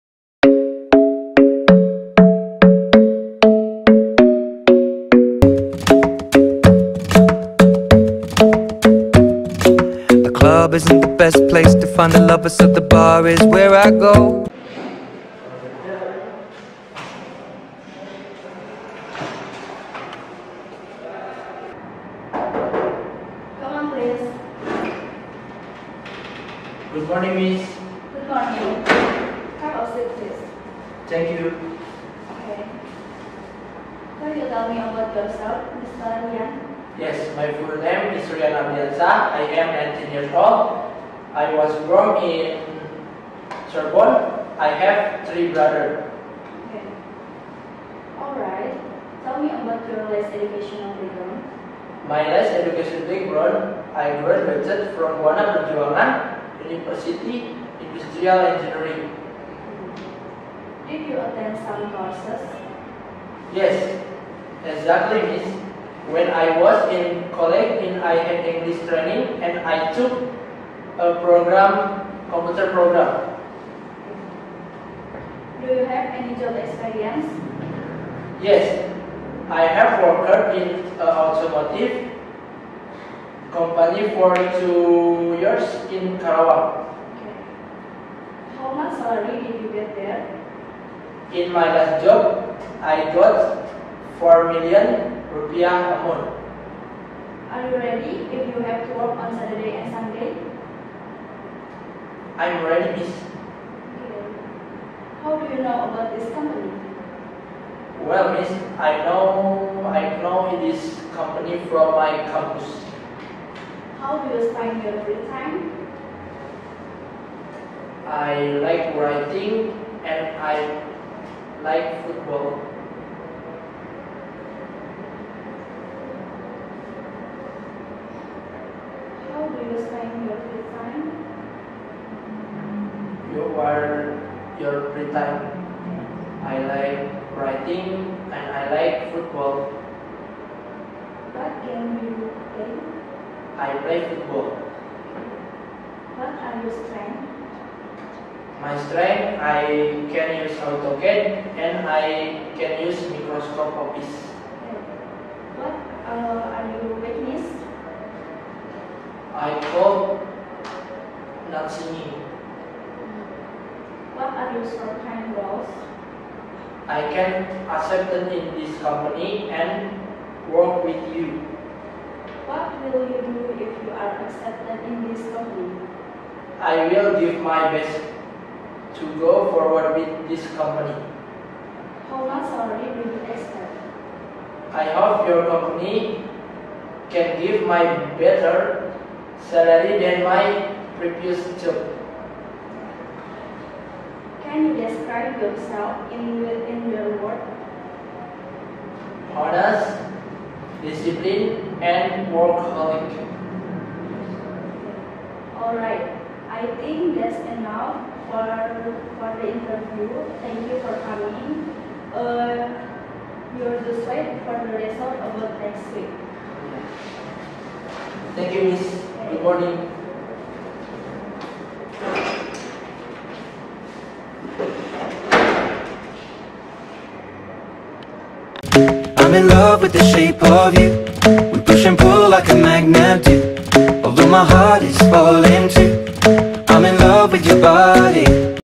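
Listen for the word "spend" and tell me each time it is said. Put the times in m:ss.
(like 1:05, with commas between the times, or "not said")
1:54, 2:09.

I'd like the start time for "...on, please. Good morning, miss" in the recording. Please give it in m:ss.
0:23.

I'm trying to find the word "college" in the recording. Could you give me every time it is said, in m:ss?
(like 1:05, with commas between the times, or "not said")
1:07.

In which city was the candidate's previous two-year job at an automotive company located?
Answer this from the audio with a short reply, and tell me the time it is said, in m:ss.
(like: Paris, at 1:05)
Karawang, at 1:26.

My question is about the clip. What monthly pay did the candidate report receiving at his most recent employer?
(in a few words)
4 million rupiah.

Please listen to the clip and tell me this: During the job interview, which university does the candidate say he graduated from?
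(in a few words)
Buana Perjuangan University.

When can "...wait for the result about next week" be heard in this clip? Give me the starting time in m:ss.
3:34.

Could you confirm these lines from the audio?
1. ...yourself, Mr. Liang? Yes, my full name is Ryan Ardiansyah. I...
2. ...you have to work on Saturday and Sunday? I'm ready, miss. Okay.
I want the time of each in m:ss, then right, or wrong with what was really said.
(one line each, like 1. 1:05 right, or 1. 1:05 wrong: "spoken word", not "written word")
1. 0:35 right
2. 1:38 right.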